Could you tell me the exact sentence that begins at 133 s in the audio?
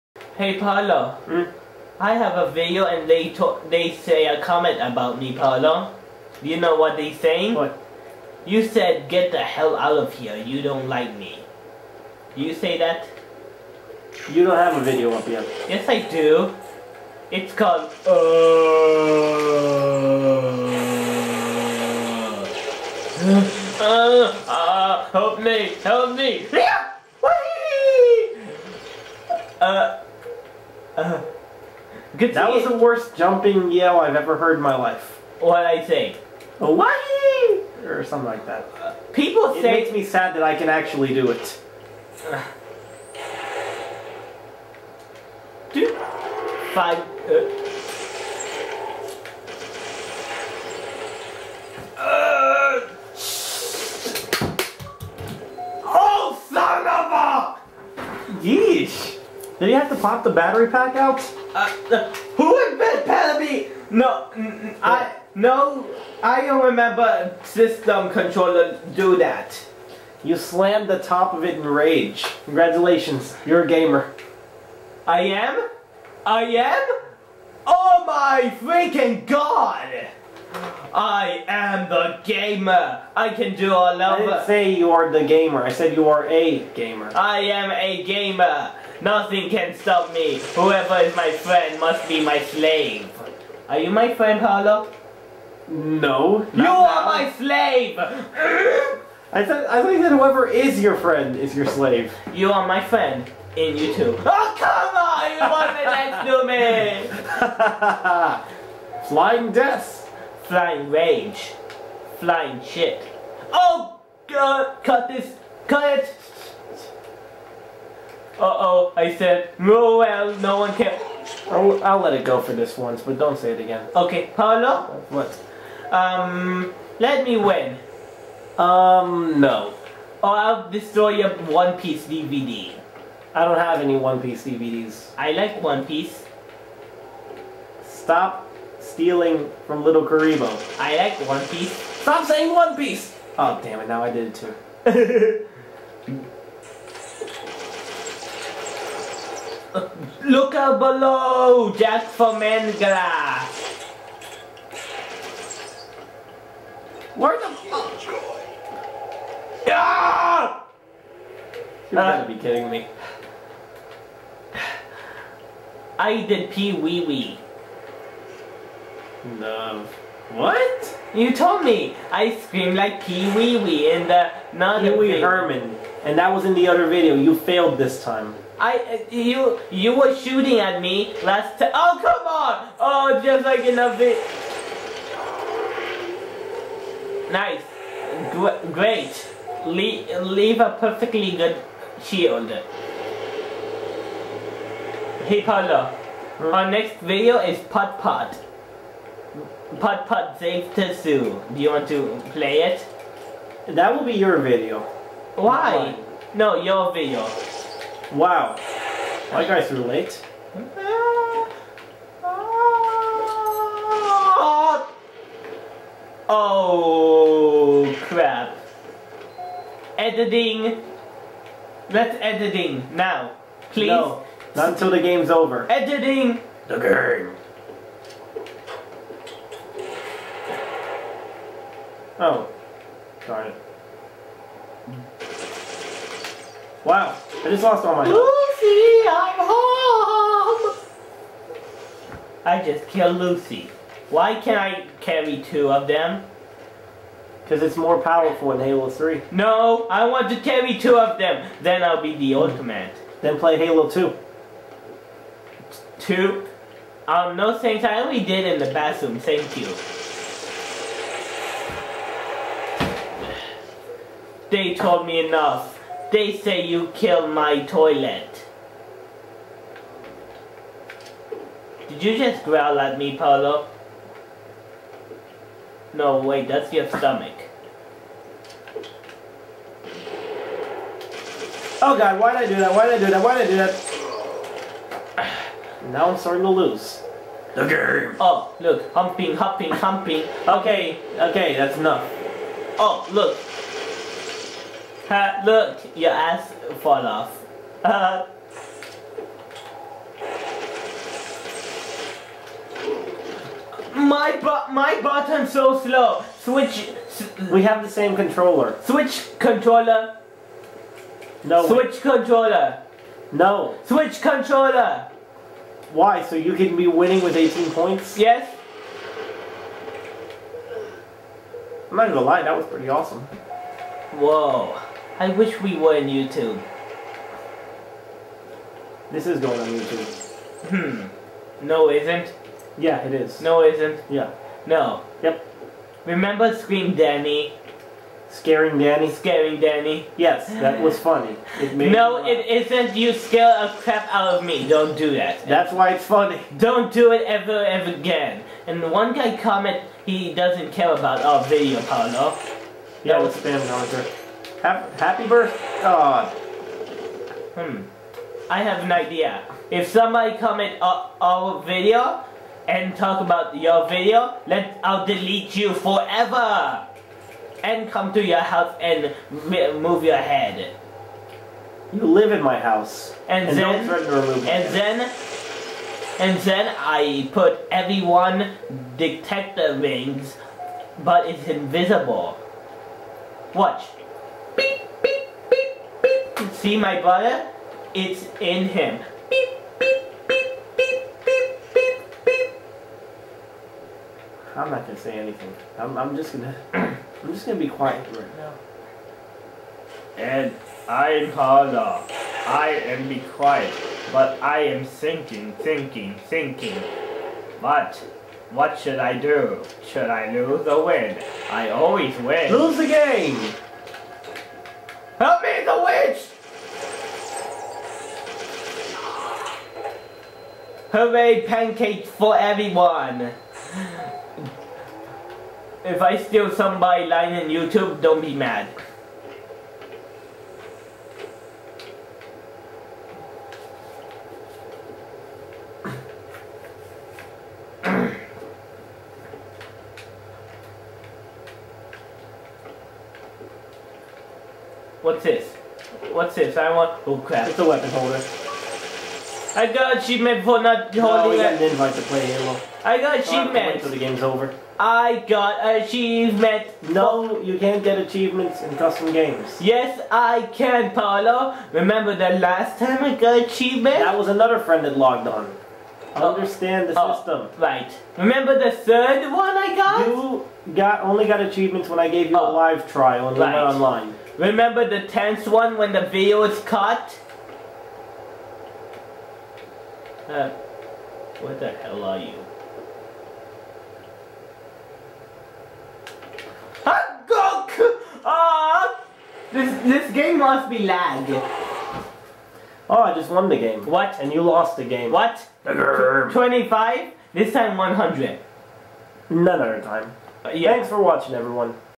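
I don't have any One Piece DVDs.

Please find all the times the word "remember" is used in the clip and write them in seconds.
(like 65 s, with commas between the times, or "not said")
66 s, 336 s, 461 s, 468 s, 474 s.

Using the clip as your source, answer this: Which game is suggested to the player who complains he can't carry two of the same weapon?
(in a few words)
Halo 2.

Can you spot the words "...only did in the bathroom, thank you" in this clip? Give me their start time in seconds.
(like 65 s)
257 s.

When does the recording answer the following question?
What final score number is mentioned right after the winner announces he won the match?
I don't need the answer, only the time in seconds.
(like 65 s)
495 s.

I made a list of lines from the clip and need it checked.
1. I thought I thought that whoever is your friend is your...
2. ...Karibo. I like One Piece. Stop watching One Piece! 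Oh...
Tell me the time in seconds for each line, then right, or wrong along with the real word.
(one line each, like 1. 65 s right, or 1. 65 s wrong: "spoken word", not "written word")
1. 97 s right
2. 140 s wrong: "saying", not "watching".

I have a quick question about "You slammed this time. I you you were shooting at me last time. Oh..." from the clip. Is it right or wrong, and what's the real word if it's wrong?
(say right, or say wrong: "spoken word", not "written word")
wrong: "failed", not "slammed".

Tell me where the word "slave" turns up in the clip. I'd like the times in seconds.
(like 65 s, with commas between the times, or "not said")
92 s, 97 s, 101 s.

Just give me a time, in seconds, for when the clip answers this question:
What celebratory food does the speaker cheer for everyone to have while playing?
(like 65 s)
421 s.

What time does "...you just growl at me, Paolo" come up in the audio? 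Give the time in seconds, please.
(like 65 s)
272 s.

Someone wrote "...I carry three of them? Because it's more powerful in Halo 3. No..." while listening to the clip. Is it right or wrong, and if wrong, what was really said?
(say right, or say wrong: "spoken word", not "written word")
wrong: "two", not "three".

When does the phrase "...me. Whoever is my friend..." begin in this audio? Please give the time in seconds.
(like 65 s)
90 s.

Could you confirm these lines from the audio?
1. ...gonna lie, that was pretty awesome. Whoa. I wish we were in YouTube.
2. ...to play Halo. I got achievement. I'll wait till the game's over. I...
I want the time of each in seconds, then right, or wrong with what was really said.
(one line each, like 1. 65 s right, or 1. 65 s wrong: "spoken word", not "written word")
1. 322 s right
2. 451 s right.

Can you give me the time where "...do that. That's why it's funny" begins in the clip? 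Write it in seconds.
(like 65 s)
344 s.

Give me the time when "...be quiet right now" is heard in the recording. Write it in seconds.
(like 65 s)
397 s.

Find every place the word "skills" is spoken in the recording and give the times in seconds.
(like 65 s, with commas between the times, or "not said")
not said.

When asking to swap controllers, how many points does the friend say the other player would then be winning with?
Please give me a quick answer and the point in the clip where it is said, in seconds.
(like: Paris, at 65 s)
18, at 317 s.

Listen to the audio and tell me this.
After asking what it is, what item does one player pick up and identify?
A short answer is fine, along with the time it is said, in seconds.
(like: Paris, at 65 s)
Weapon holder, at 447 s.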